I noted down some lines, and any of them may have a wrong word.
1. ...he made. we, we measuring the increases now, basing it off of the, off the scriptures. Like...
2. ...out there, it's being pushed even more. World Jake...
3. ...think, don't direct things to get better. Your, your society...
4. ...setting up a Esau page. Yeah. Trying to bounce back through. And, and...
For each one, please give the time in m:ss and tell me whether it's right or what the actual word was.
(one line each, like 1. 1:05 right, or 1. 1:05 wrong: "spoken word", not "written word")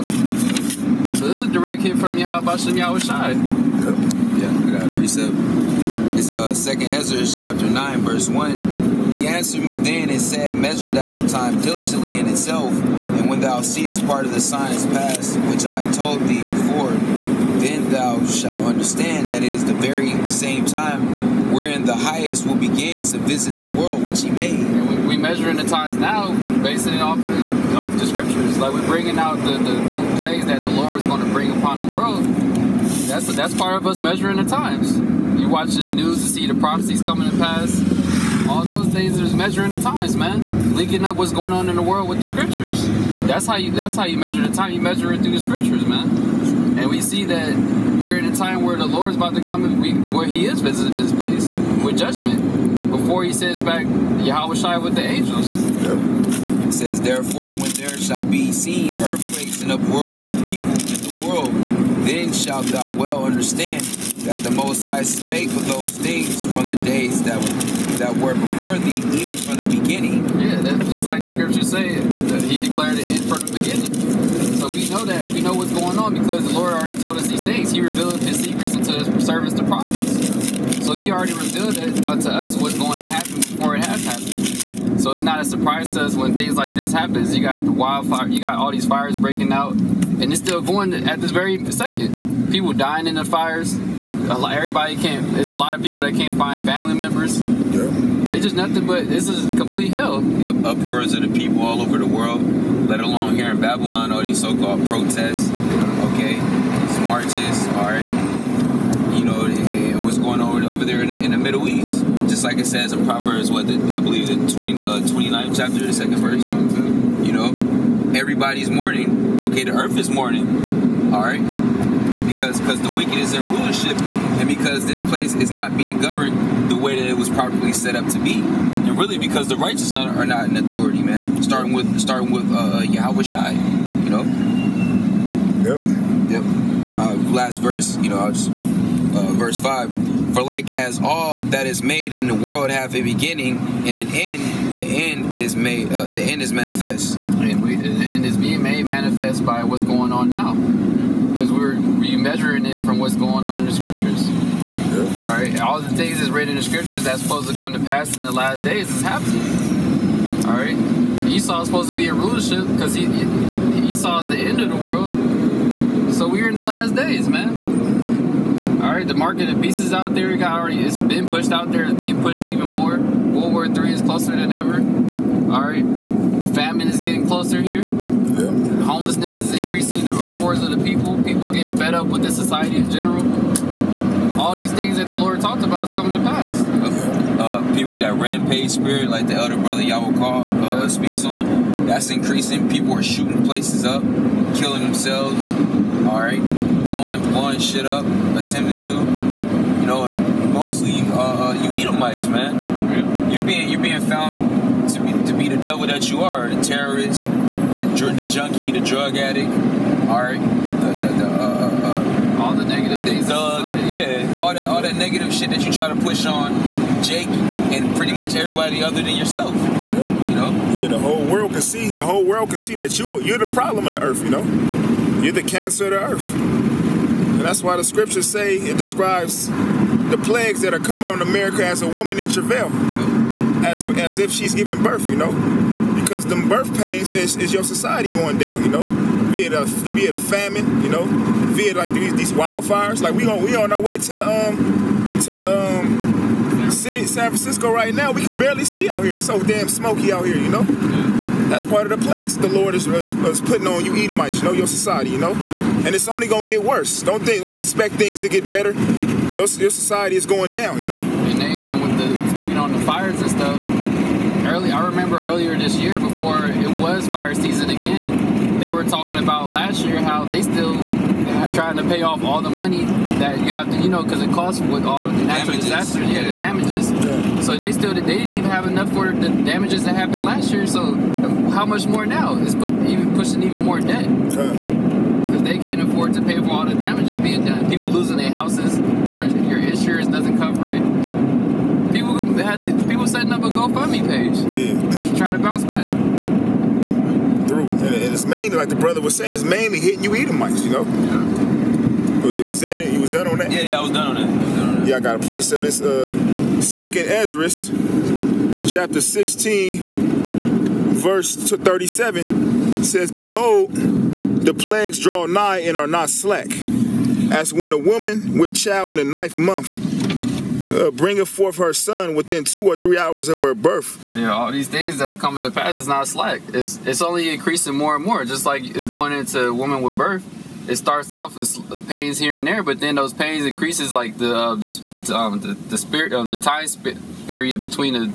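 1. 0:24 wrong: "times", not "increases"
2. 2:51 wrong: "War", not "Jake"
3. 4:17 wrong: "expect", not "direct"
4. 4:53 wrong: "GoFundMe", not "Esau".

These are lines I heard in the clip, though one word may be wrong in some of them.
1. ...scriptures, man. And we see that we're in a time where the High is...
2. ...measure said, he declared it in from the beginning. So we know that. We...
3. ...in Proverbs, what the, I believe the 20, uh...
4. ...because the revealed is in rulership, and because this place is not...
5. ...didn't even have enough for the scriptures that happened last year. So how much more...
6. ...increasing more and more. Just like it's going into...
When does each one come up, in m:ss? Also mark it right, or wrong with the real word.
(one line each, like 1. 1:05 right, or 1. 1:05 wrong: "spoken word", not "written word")
1. 0:45 wrong: "Lord", not "High"
2. 1:11 wrong: "scripture", not "measure"
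3. 1:52 right
4. 2:02 wrong: "wicked", not "revealed"
5. 4:38 wrong: "damages", not "scriptures"
6. 5:27 right.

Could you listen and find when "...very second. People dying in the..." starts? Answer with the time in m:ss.
1:31.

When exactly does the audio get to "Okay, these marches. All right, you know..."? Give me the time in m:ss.
1:45.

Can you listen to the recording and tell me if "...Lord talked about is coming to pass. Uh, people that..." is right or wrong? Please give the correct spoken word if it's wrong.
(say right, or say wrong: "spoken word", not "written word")
right.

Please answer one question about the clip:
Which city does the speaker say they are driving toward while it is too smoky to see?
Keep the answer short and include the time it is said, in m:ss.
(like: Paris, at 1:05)
San Francisco, at 4:07.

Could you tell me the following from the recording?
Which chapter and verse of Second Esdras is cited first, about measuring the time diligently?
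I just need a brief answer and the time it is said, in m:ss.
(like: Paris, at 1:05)
Chapter 9, verse 1, at 0:07.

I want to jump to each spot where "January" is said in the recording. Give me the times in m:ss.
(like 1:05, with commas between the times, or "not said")
not said.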